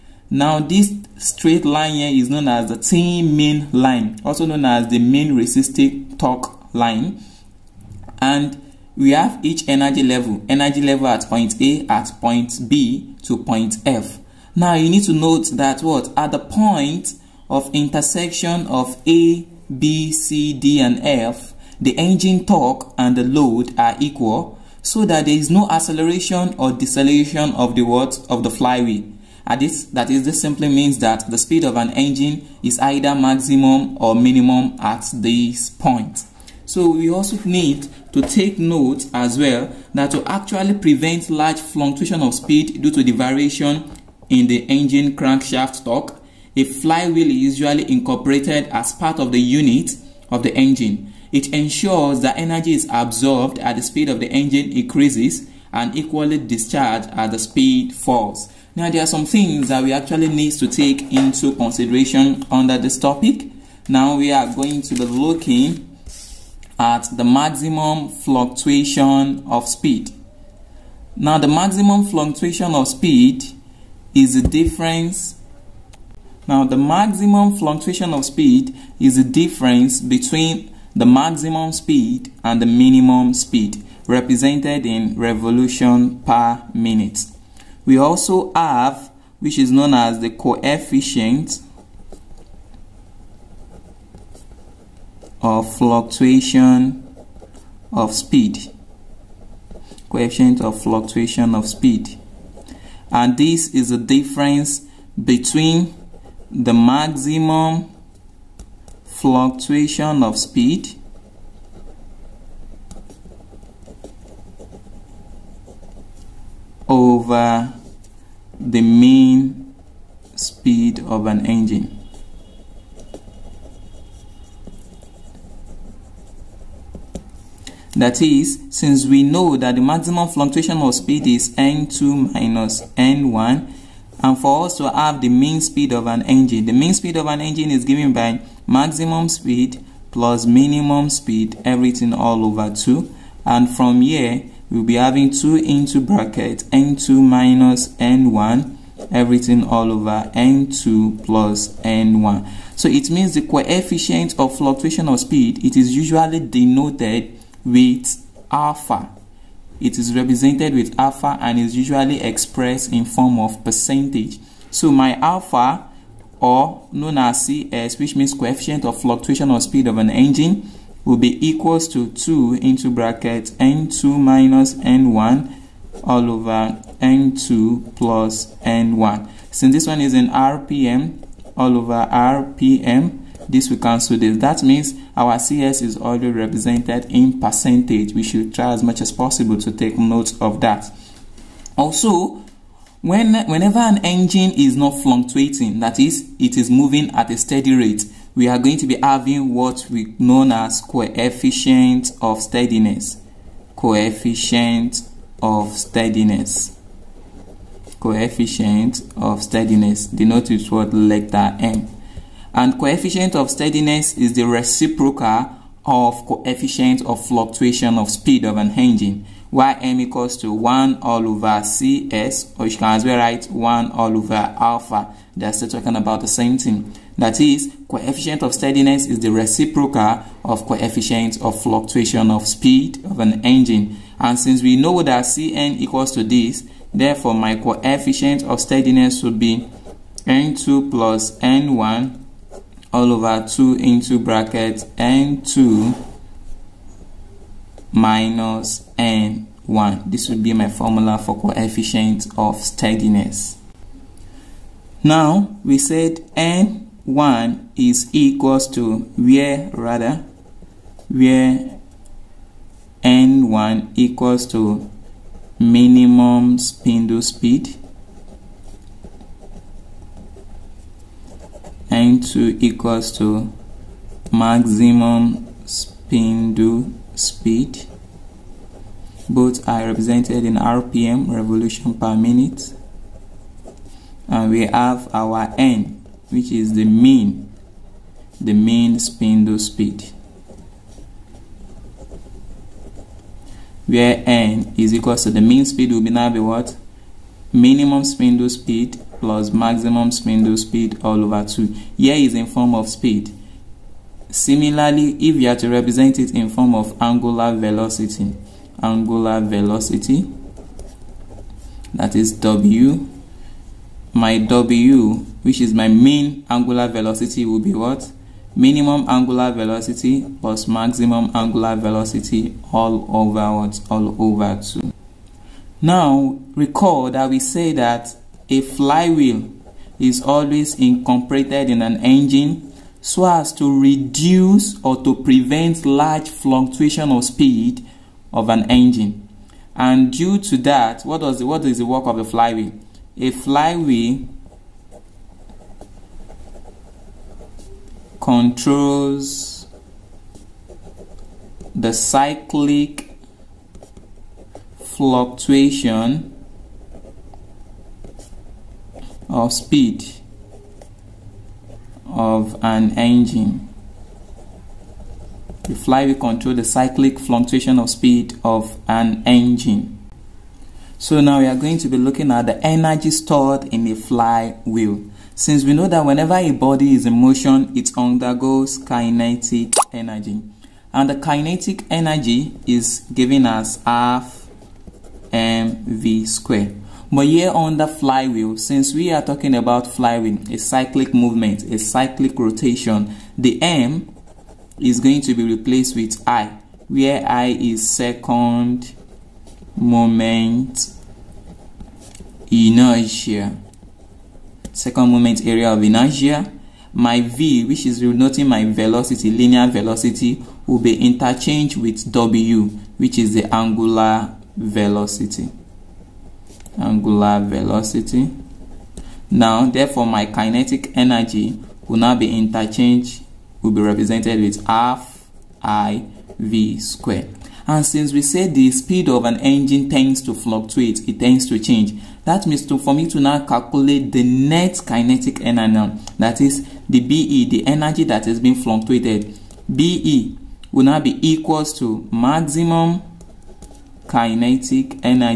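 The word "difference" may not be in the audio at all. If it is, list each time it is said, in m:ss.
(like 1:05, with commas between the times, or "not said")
1:14, 1:19, 1:43.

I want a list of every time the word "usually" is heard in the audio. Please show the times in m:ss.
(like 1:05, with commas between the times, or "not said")
0:47, 2:35, 2:41.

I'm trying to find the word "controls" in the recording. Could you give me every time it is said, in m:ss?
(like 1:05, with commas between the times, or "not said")
5:48, 6:06.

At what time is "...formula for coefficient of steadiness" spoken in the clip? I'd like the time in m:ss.
4:10.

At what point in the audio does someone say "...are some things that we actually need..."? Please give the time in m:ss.
0:59.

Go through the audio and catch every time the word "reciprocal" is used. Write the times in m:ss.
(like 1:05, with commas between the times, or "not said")
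3:34, 3:49.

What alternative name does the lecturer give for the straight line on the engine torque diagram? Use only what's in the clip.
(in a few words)
main resistive torque line.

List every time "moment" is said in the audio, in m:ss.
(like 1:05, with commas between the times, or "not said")
6:39, 6:45.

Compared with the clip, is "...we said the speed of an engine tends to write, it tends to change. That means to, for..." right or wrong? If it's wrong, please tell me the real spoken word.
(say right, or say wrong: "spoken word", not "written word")
wrong: "fluctuate", not "write".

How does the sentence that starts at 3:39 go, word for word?
Ym equals to 1 all over Cs, or you can as well write 1 all over alpha.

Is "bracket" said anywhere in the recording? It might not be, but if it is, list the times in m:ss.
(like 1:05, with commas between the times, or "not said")
2:26, 2:52, 4:04.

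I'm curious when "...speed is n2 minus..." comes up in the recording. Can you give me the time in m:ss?
2:10.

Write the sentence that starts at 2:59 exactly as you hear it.
Since this one is in RPM, all over RPM, this will cancel this.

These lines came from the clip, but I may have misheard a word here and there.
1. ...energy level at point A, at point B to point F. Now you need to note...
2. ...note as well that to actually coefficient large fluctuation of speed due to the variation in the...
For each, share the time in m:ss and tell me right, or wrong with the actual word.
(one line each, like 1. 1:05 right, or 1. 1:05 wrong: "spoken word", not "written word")
1. 0:10 right
2. 0:38 wrong: "prevent", not "coefficient".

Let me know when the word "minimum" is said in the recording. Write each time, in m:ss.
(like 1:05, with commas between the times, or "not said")
0:34, 1:22, 2:20, 4:25, 4:57, 5:18.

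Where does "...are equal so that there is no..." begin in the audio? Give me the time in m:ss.
0:23.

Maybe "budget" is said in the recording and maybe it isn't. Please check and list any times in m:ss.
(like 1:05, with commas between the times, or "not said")
not said.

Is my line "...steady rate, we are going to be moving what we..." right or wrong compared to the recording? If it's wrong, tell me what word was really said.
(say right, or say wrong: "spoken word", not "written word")
wrong: "having", not "moving".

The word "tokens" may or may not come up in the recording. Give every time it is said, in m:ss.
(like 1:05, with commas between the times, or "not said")
not said.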